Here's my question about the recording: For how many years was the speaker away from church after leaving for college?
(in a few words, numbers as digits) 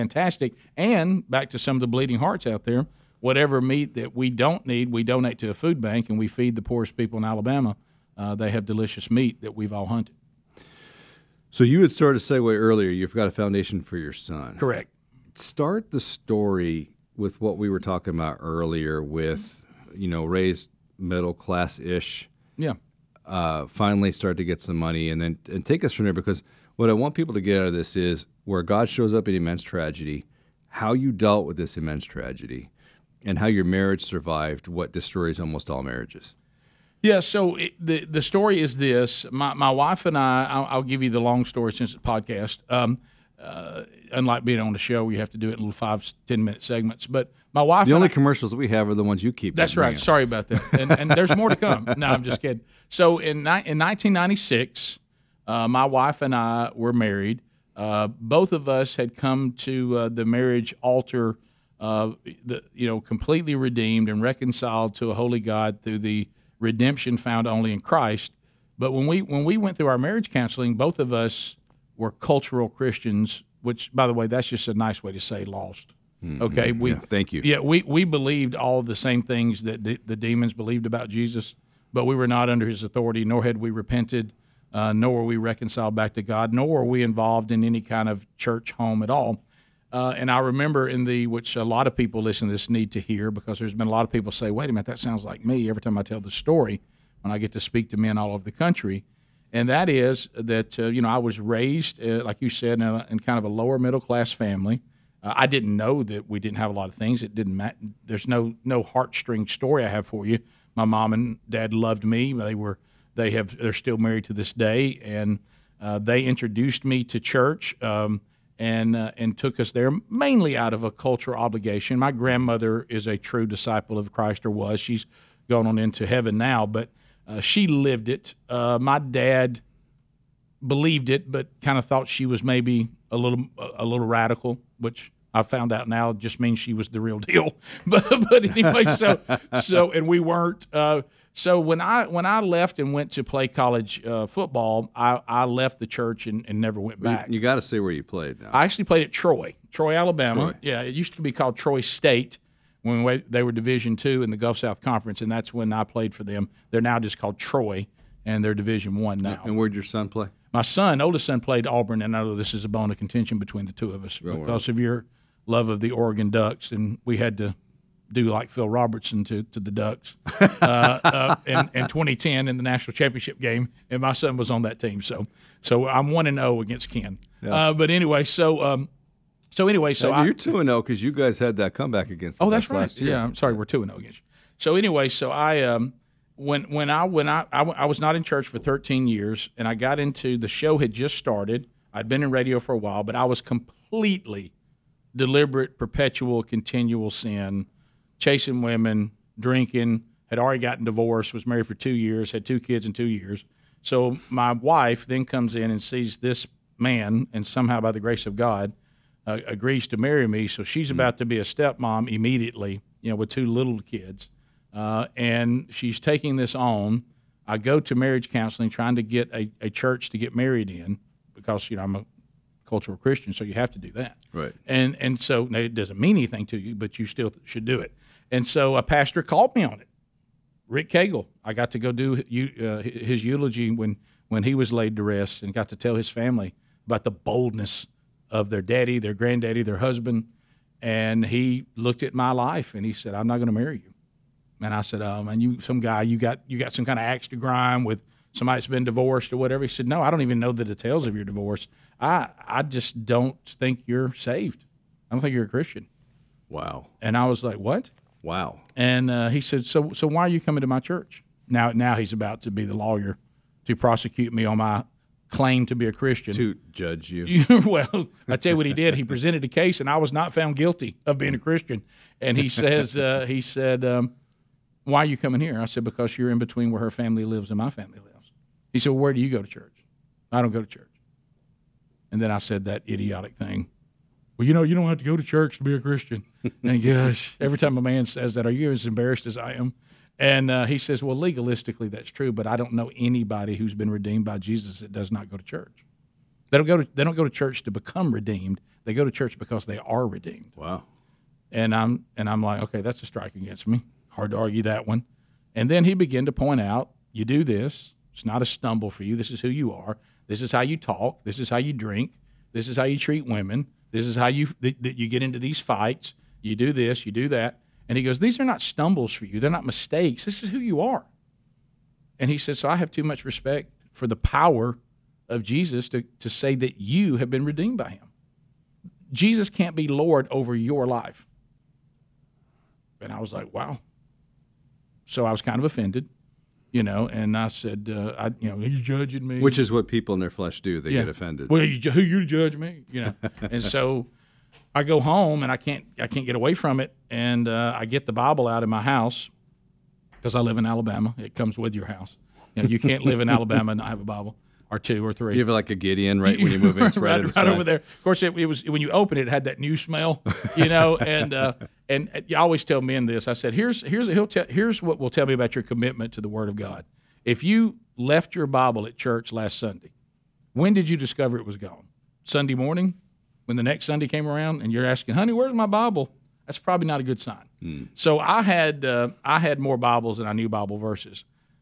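13.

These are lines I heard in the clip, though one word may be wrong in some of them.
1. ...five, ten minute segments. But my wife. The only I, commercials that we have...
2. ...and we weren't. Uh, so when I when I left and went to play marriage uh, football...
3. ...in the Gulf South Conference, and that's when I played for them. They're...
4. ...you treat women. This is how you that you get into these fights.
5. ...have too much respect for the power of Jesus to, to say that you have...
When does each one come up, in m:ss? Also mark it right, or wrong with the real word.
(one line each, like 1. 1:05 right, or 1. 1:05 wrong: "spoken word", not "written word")
1. 0:45 right
2. 2:19 wrong: "college", not "marriage"
3. 2:34 right
4. 5:12 right
5. 5:22 right.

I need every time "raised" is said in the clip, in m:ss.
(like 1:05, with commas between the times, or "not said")
0:20, 1:41.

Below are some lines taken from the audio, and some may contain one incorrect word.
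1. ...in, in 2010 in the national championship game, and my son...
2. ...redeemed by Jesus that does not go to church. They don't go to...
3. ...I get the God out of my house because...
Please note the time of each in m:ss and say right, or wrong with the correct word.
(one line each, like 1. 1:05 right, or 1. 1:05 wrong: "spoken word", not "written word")
1. 2:51 right
2. 4:53 right
3. 5:47 wrong: "Bible", not "God".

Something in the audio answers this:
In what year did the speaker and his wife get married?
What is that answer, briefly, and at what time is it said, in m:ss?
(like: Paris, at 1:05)
1996, at 0:53.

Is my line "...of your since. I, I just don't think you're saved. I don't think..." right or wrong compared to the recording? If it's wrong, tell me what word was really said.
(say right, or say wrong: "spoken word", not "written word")
wrong: "divorce", not "since".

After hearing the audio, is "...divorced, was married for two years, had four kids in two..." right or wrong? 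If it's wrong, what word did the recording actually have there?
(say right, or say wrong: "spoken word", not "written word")
wrong: "two", not "four".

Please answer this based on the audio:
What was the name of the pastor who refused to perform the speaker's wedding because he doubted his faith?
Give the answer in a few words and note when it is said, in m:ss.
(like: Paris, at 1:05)
Rick Cagle, at 3:50.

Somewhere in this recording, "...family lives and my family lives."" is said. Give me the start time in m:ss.
4:36.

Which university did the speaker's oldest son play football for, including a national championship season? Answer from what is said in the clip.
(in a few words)
Auburn.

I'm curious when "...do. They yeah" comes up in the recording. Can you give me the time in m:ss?
5:40.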